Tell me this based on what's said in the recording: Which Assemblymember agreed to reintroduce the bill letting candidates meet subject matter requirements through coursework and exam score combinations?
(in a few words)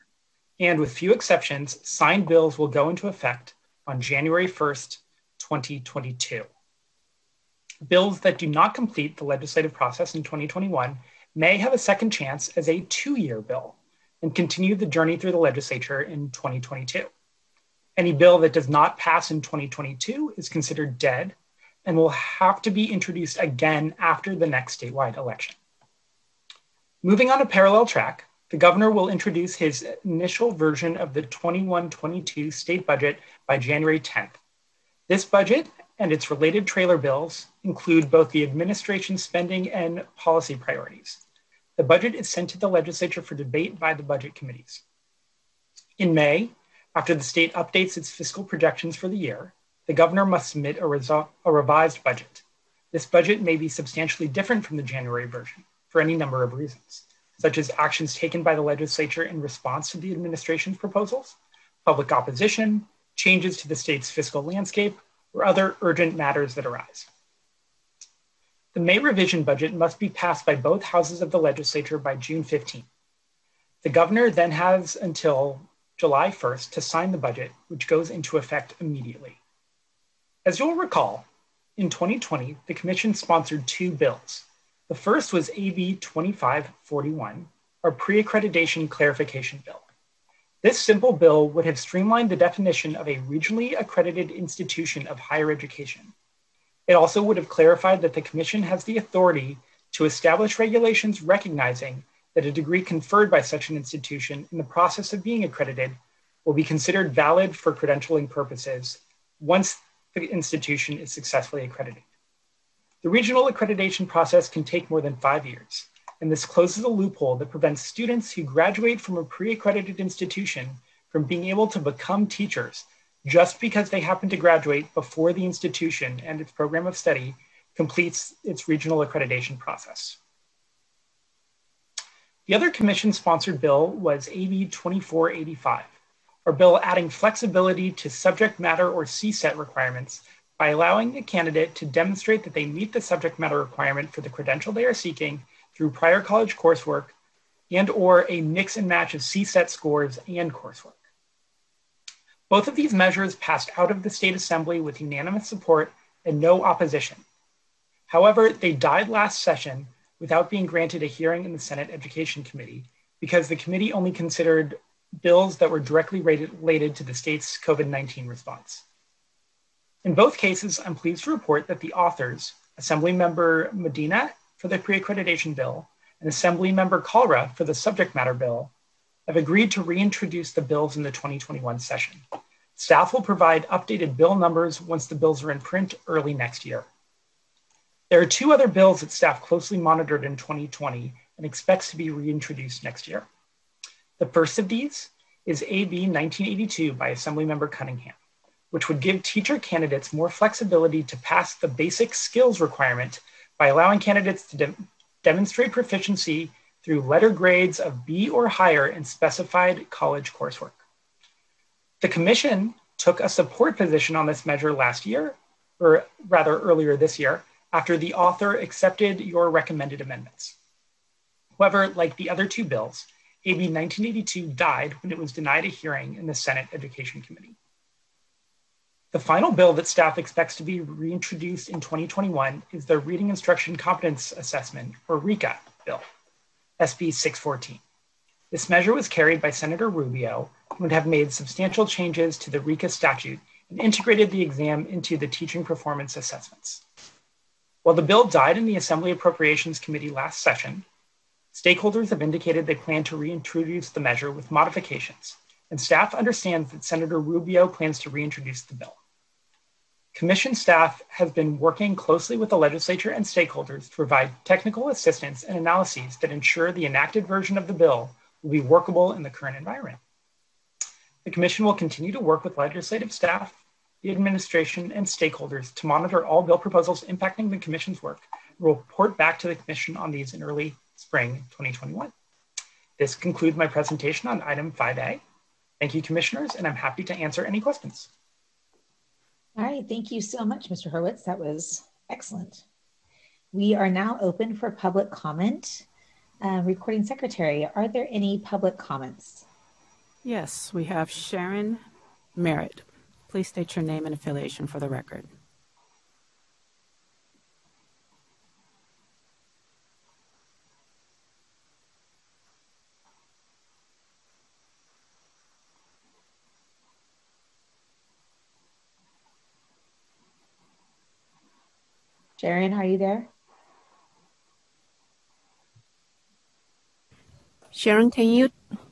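Kalra.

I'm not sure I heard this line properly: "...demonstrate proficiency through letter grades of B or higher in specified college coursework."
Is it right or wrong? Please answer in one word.
right.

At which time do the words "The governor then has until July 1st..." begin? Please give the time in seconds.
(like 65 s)
73 s.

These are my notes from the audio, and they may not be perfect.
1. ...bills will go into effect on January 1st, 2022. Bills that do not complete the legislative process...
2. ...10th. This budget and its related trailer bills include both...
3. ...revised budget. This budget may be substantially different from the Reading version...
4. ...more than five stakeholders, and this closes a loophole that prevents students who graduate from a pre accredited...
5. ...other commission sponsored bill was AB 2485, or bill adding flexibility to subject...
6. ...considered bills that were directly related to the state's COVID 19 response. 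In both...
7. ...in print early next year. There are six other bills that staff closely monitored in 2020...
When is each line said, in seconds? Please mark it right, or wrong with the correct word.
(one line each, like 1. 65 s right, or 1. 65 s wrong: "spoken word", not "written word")
1. 2 s right
2. 34 s right
3. 51 s wrong: "January", not "Reading"
4. 114 s wrong: "years", not "stakeholders"
5. 132 s right
6. 164 s right
7. 185 s wrong: "two", not "six".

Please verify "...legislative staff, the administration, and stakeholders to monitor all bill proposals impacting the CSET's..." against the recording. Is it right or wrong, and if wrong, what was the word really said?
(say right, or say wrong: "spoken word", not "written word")
wrong: "Commission", not "CSET".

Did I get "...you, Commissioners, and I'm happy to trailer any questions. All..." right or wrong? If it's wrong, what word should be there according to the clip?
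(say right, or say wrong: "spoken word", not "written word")
wrong: "answer", not "trailer".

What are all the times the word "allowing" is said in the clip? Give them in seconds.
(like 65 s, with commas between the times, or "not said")
140 s, 203 s.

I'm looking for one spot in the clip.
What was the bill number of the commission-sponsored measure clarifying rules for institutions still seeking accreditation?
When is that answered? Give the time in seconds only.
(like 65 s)
85 s.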